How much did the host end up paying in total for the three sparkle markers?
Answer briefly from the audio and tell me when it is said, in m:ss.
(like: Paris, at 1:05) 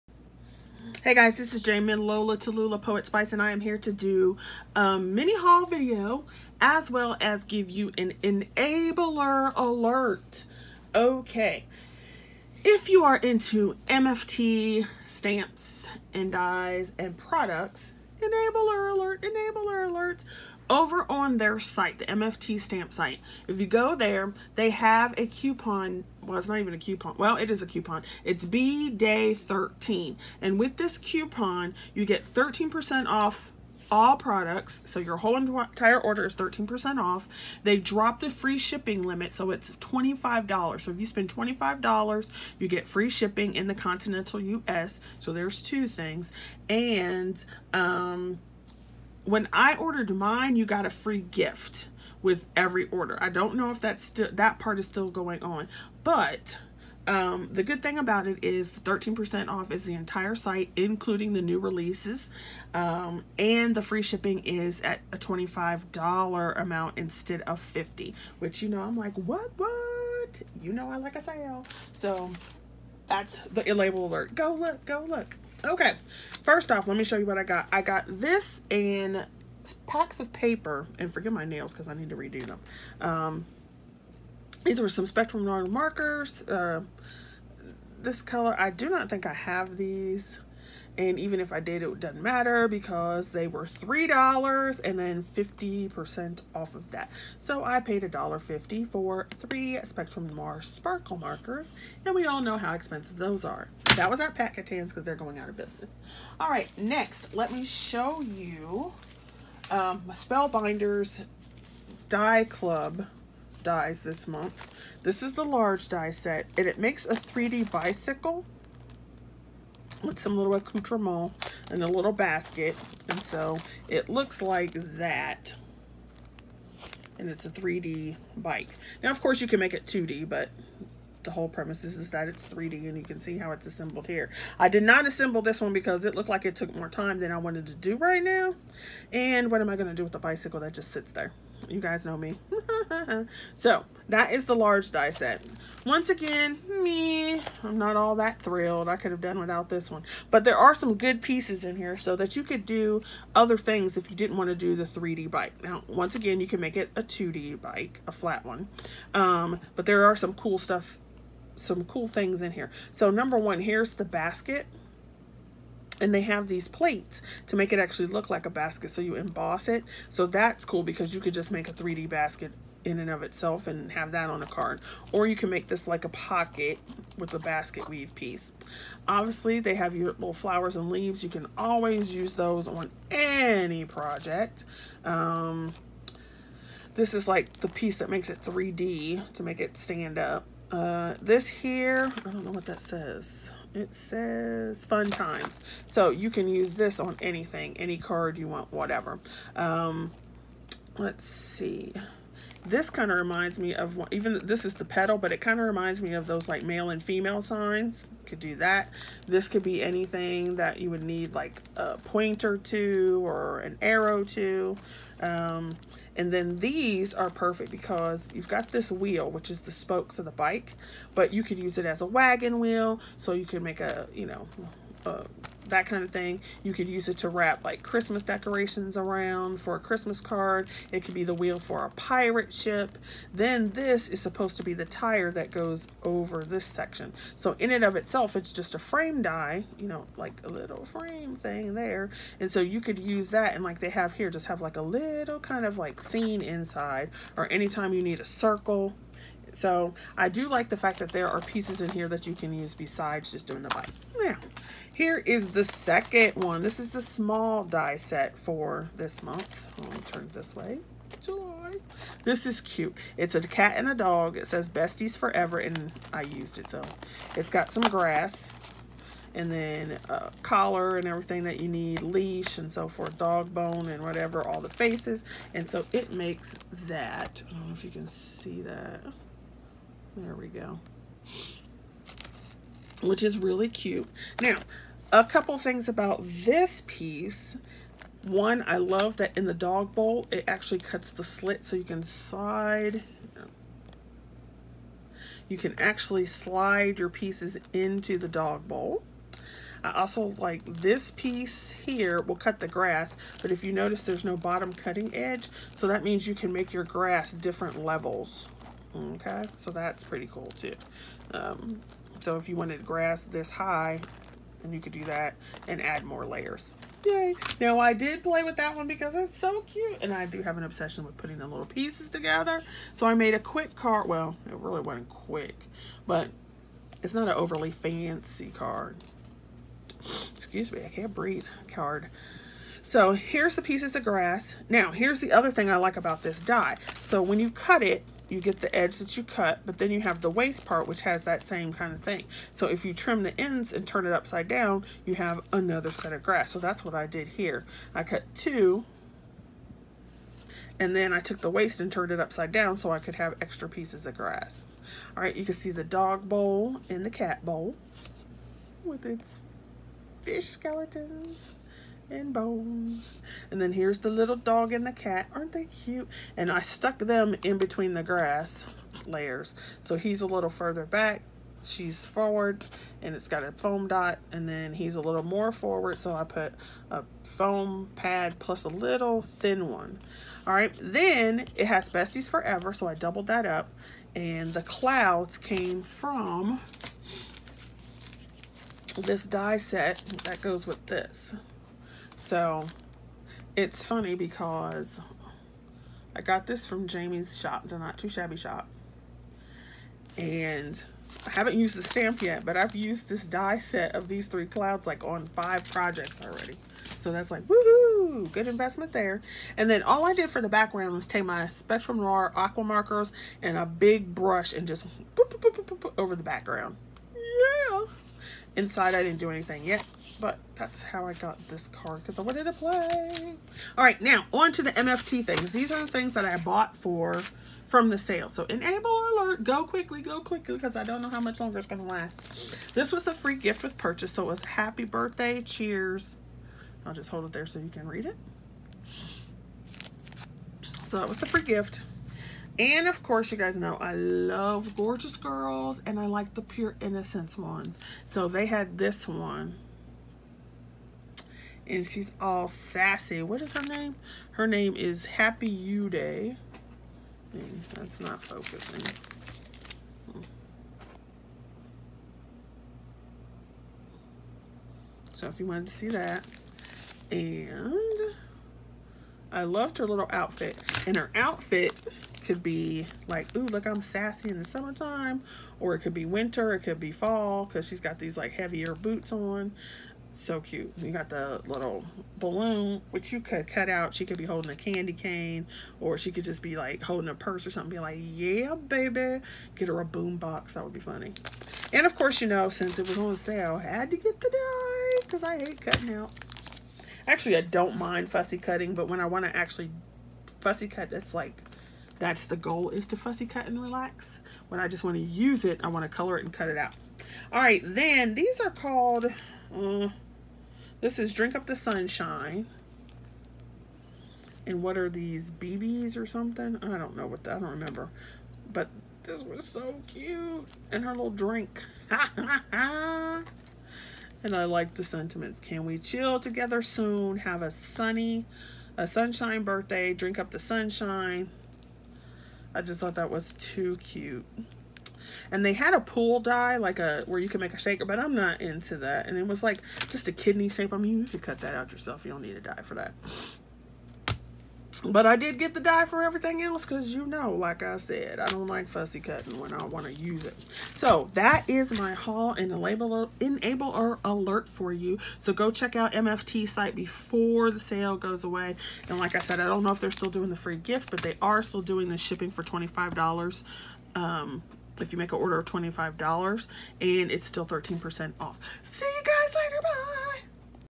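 $1.50, at 1:38.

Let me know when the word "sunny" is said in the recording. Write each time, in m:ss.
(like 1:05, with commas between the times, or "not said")
8:47.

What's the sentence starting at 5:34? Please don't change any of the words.
Now, here's the other thing I like about this die.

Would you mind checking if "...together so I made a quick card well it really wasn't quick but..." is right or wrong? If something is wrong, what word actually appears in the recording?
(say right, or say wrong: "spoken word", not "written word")
right.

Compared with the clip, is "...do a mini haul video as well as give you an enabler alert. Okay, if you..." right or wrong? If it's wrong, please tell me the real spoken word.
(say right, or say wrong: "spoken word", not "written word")
right.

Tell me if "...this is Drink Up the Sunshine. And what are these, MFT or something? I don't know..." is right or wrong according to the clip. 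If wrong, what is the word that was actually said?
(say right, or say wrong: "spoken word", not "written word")
wrong: "BBs", not "MFT".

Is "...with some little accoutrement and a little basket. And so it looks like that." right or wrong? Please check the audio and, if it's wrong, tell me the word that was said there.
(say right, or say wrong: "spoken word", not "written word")
right.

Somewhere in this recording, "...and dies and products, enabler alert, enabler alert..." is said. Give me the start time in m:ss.
0:16.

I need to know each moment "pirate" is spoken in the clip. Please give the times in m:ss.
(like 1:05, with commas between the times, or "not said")
3:51.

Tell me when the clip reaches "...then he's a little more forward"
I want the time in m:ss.
6:14.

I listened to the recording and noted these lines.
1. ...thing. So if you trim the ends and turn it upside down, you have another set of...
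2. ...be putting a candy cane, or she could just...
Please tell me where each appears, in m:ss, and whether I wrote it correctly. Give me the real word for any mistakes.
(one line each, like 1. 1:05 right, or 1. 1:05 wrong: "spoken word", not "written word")
1. 5:42 right
2. 8:04 wrong: "holding", not "putting".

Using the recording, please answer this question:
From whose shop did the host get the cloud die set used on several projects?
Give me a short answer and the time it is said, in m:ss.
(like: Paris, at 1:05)
Not Too Shabby shop, at 6:37.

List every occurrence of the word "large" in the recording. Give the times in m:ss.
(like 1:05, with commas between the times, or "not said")
1:55, 2:24.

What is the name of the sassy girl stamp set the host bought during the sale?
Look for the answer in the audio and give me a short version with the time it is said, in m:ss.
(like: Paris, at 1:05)
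Happy You Day, at 7:35.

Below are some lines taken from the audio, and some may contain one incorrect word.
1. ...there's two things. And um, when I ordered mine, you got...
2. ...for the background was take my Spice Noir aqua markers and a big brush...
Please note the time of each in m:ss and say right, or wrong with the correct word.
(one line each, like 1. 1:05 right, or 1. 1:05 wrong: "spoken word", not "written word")
1. 0:45 right
2. 6:50 wrong: "Spectrum", not "Spice".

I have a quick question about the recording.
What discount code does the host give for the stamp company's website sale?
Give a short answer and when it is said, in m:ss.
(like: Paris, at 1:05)
B Day 13, at 0:28.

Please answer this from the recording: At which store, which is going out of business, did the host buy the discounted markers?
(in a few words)
Pat Catan's.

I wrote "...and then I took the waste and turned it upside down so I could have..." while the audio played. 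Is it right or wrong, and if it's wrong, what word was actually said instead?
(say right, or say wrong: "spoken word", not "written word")
right.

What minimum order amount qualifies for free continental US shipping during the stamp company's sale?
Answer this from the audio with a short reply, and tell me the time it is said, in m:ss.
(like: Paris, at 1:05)
$25, at 0:39.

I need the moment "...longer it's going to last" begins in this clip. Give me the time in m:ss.
7:11.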